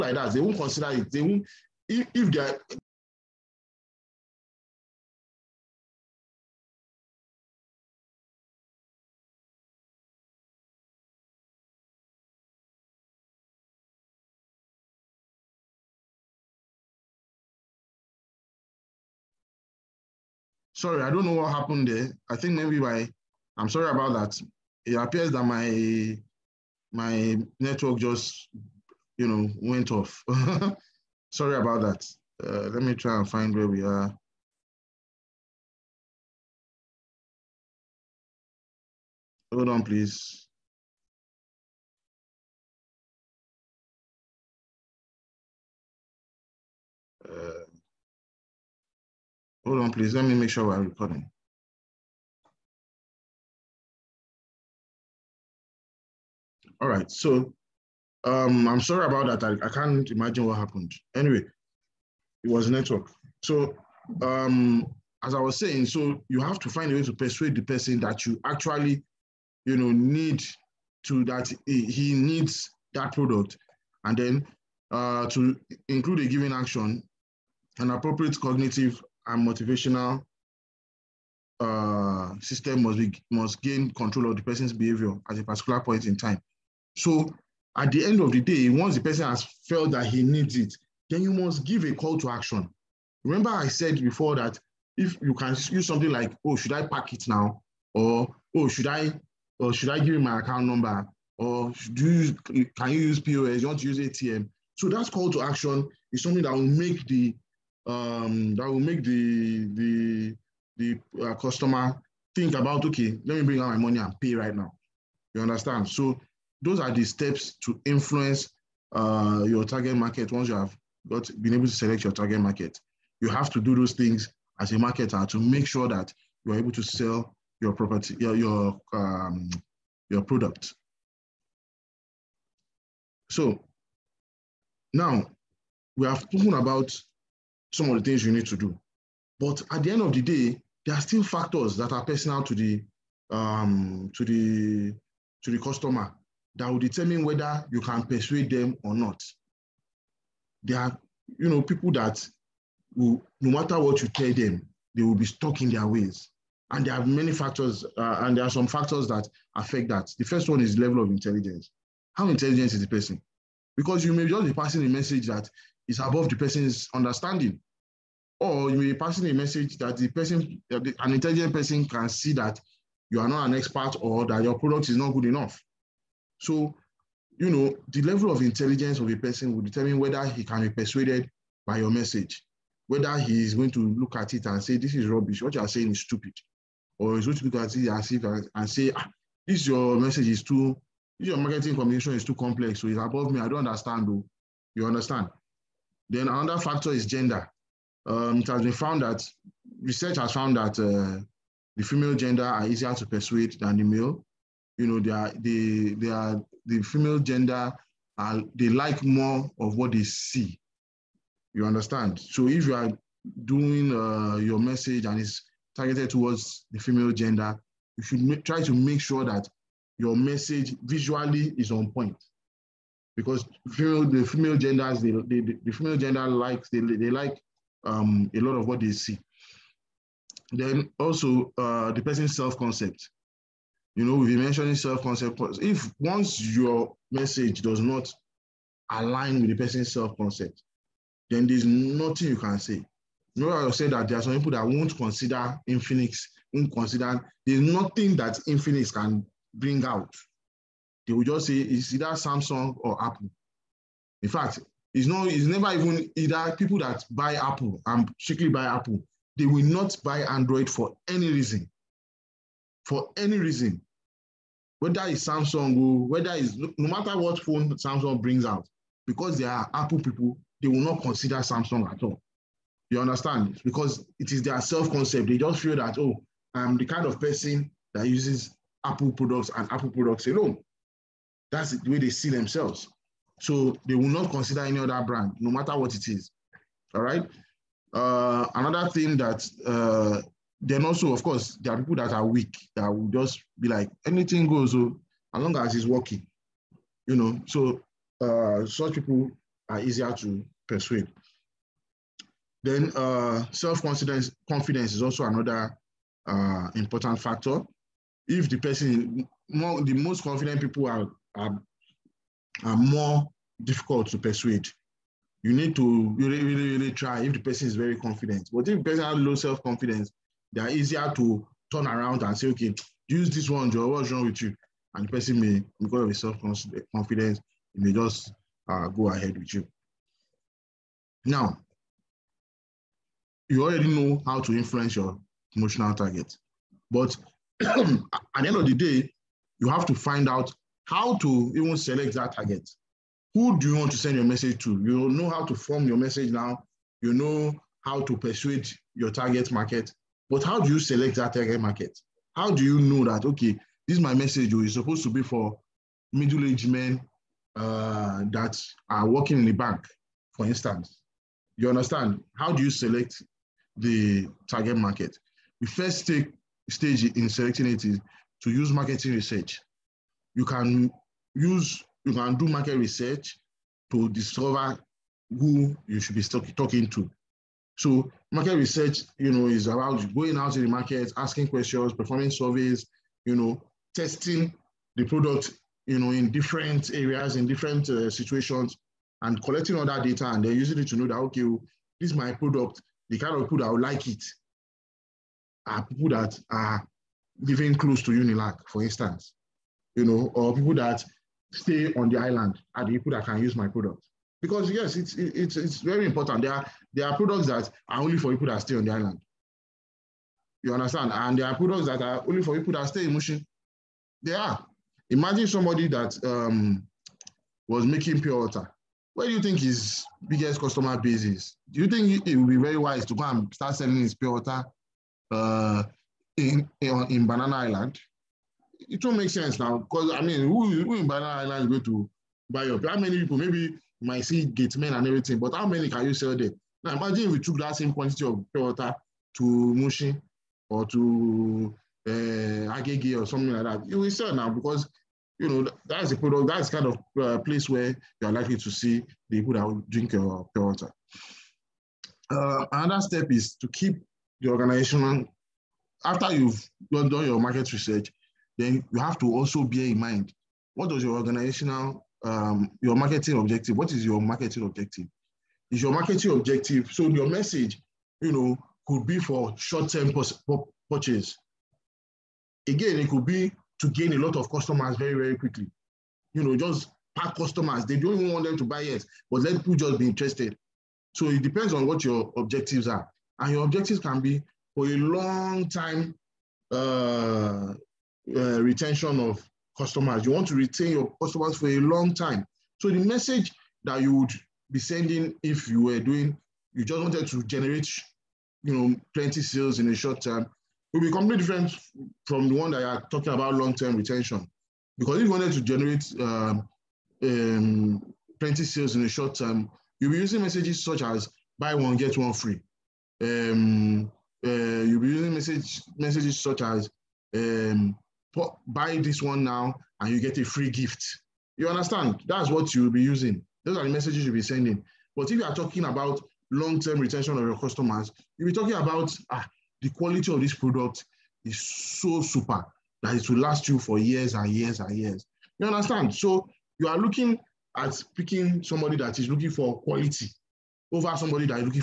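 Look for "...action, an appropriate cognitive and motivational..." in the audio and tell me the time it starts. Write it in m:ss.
1:16.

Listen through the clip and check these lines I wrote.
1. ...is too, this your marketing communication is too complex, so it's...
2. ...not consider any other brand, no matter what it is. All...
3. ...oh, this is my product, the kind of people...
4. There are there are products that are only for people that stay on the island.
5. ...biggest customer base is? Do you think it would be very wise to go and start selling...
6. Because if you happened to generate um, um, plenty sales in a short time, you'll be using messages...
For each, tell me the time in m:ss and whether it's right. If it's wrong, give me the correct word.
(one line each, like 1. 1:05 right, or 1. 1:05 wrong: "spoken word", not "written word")
1. 3:10 right
2. 4:44 right
3. 6:31 right
4. 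6:46 right
5. 7:00 right
6. 8:24 wrong: "wanted", not "happened".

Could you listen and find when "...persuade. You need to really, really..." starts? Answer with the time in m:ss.
5:14.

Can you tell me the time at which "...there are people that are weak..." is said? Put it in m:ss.
4:51.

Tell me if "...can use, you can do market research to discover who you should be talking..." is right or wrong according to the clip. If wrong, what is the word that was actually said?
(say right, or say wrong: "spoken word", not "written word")
right.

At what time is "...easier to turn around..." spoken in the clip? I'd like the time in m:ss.
5:20.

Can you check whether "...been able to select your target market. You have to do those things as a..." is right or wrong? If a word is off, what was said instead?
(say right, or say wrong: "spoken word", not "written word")
right.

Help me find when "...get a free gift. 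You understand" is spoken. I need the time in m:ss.
8:40.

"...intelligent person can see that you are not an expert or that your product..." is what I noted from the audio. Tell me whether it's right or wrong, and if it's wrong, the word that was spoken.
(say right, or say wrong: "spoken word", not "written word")
right.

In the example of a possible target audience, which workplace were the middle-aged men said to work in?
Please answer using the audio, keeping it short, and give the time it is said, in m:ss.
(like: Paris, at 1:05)
The bank, at 5:59.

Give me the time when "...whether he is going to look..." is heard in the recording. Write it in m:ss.
3:02.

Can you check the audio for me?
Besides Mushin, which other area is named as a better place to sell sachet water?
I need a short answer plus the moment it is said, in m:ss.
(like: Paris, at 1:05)
Agege, at 7:22.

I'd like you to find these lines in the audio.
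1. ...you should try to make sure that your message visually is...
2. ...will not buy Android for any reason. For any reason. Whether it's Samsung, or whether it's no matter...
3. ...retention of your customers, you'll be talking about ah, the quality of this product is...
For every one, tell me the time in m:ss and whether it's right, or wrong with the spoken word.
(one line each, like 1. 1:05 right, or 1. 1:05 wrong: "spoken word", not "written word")
1. 3:37 right
2. 4:19 right
3. 8:46 right.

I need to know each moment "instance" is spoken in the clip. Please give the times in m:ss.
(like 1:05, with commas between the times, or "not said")
6:00, 6:38.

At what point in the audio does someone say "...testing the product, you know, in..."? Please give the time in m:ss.
6:23.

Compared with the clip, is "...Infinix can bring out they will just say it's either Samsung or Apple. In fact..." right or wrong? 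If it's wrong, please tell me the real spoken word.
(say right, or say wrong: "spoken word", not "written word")
right.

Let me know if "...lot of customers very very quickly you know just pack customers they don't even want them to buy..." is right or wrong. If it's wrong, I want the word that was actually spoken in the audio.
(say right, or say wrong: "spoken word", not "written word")
right.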